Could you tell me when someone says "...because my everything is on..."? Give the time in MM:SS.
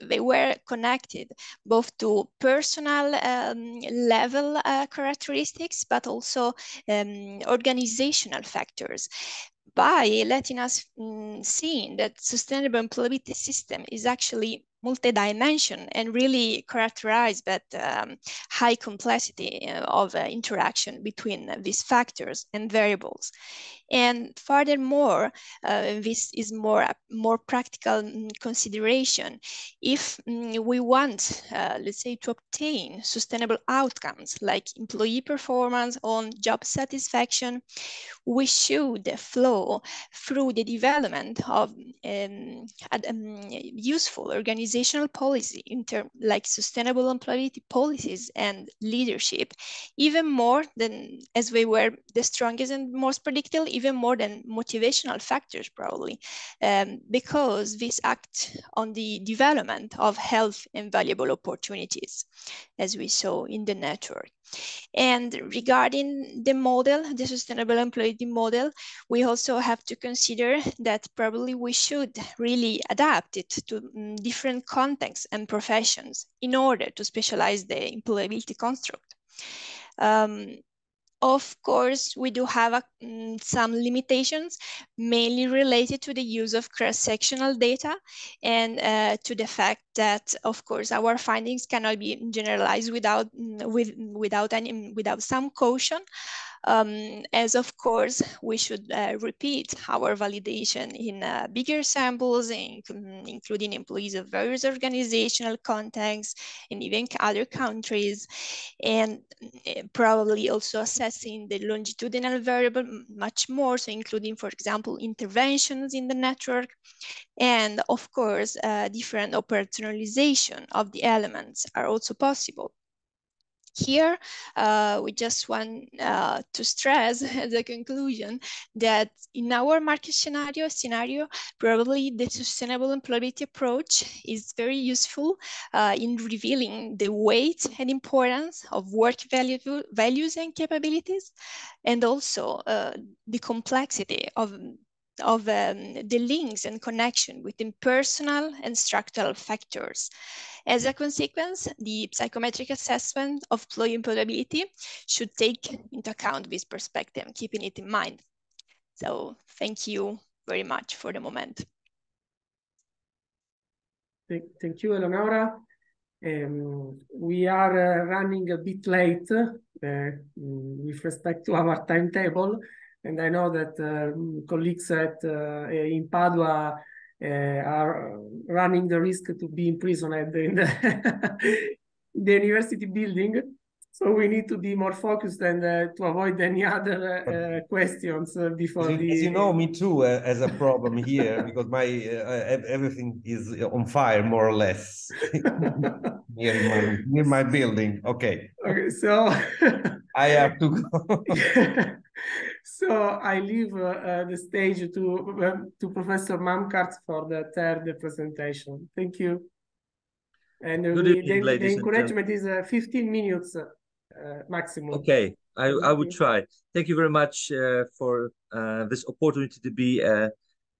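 03:11.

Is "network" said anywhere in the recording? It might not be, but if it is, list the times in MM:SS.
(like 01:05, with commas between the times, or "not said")
01:03, 01:56.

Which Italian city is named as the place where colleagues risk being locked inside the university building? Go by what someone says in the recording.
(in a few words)
Padua.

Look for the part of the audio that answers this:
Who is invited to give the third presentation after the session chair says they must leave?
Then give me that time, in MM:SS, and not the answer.
03:25.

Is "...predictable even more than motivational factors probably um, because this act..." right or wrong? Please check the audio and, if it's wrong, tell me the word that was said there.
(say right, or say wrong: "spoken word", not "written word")
right.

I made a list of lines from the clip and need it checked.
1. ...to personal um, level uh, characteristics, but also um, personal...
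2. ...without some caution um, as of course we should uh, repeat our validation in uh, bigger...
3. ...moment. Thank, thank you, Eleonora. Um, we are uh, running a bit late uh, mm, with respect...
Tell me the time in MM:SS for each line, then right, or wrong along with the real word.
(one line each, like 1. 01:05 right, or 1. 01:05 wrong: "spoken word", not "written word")
1. 00:01 wrong: "organizational", not "personal"
2. 01:34 right
3. 02:41 right.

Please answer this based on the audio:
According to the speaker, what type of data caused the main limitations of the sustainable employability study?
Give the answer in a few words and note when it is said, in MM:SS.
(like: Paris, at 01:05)
Cross-sectional data, at 01:26.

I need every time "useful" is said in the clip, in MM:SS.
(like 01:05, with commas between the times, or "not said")
00:43, 02:14.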